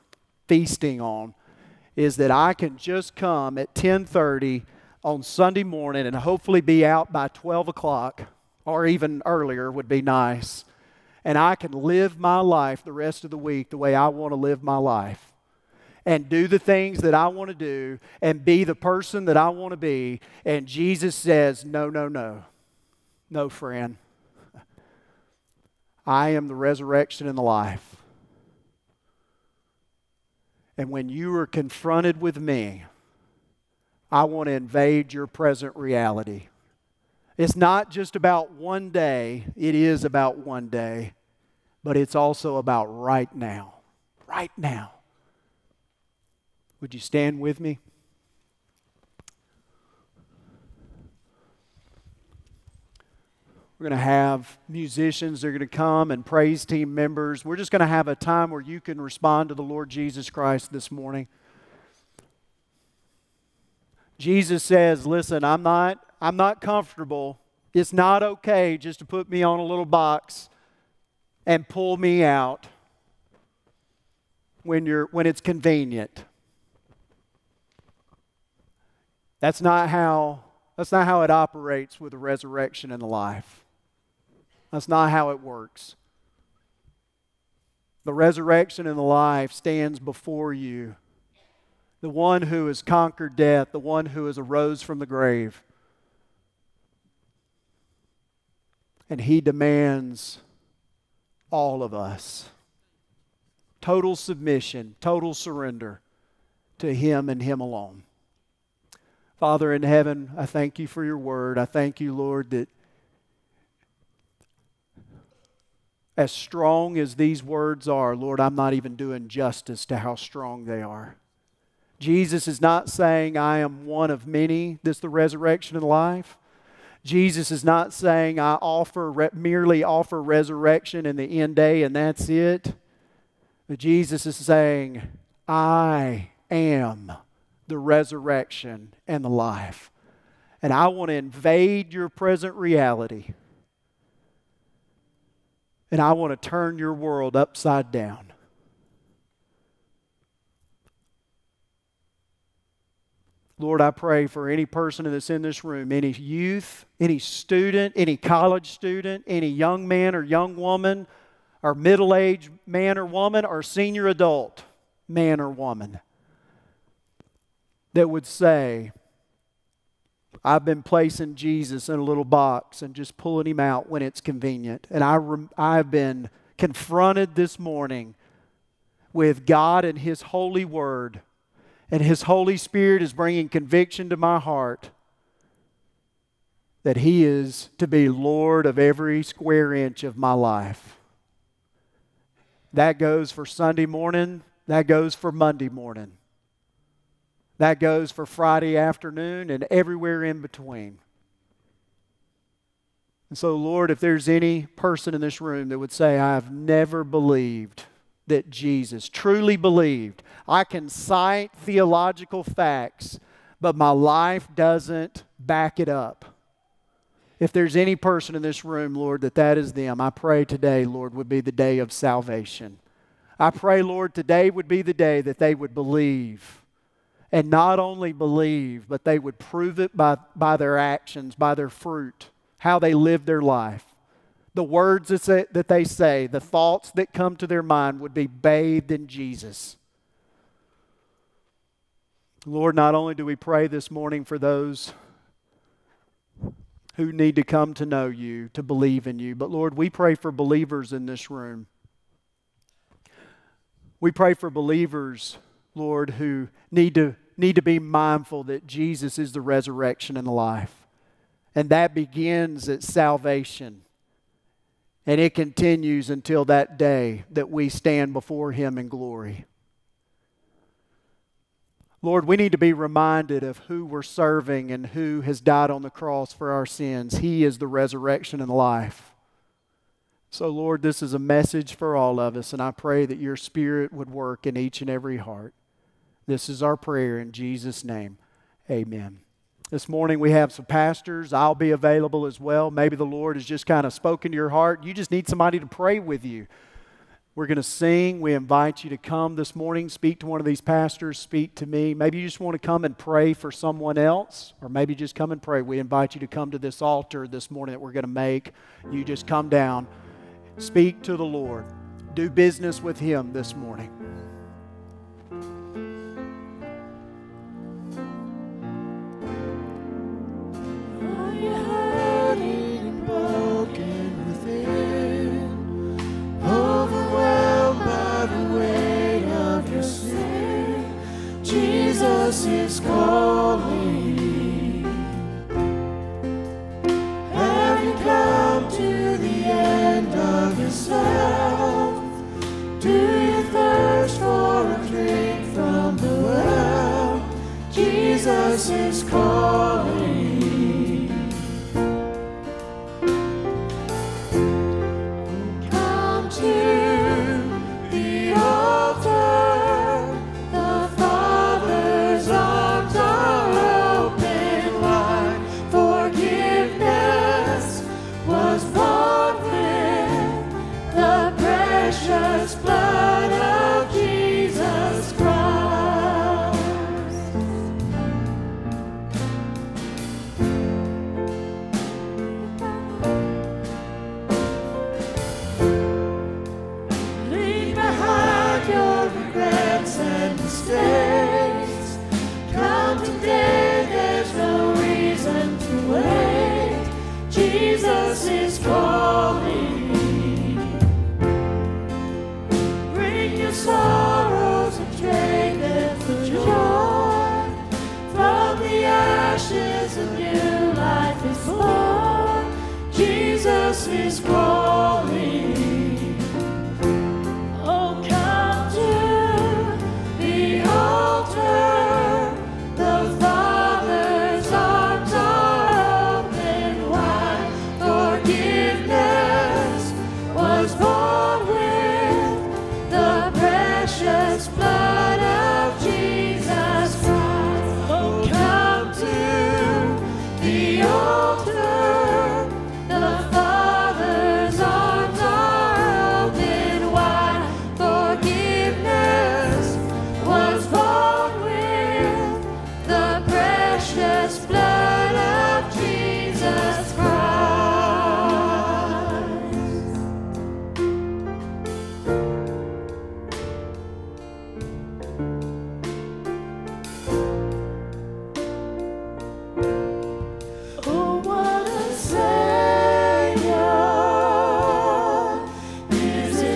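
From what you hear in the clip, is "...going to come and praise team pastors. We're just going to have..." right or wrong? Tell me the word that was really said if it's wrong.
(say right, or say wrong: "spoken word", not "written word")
wrong: "members", not "pastors".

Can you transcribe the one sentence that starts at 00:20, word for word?
And Jesus says, No, no, no.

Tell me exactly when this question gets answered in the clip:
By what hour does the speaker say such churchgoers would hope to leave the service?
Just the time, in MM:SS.
00:07.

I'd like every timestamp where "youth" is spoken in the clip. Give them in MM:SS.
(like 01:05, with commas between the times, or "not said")
02:36.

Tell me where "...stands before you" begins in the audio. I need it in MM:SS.
01:29.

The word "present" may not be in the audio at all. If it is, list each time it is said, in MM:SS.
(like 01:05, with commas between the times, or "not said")
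00:35, 02:22.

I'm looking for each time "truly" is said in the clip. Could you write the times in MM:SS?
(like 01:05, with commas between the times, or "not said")
03:29.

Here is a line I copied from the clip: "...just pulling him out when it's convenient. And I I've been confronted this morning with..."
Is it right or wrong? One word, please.
right.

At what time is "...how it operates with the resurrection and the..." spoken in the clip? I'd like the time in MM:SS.
01:21.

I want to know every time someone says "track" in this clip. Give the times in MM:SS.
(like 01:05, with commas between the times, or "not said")
not said.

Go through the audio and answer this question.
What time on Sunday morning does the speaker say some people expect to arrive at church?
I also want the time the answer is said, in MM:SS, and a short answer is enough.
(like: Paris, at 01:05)
10:30, at 00:03.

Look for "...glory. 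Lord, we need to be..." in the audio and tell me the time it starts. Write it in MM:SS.
04:28.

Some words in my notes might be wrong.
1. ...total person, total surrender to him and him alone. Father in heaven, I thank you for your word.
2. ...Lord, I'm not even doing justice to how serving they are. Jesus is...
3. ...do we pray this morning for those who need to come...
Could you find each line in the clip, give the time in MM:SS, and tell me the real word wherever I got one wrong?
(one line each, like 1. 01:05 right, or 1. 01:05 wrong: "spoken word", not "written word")
1. 01:43 wrong: "submission", not "person"
2. 01:58 wrong: "strong", not "serving"
3. 04:03 right.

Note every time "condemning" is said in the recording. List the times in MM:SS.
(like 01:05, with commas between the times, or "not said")
not said.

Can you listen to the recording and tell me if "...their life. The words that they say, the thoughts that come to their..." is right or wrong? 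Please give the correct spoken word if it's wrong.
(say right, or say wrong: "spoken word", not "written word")
right.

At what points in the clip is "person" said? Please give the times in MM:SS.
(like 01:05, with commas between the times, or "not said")
00:18, 02:34, 03:24, 03:37.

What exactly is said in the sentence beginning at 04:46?
This is our prayer in Jesus' name.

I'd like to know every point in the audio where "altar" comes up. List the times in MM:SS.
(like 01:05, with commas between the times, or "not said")
05:06.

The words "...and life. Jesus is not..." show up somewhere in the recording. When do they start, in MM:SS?
02:05.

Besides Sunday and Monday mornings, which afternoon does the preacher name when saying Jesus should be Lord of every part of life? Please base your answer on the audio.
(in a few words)
Friday afternoon.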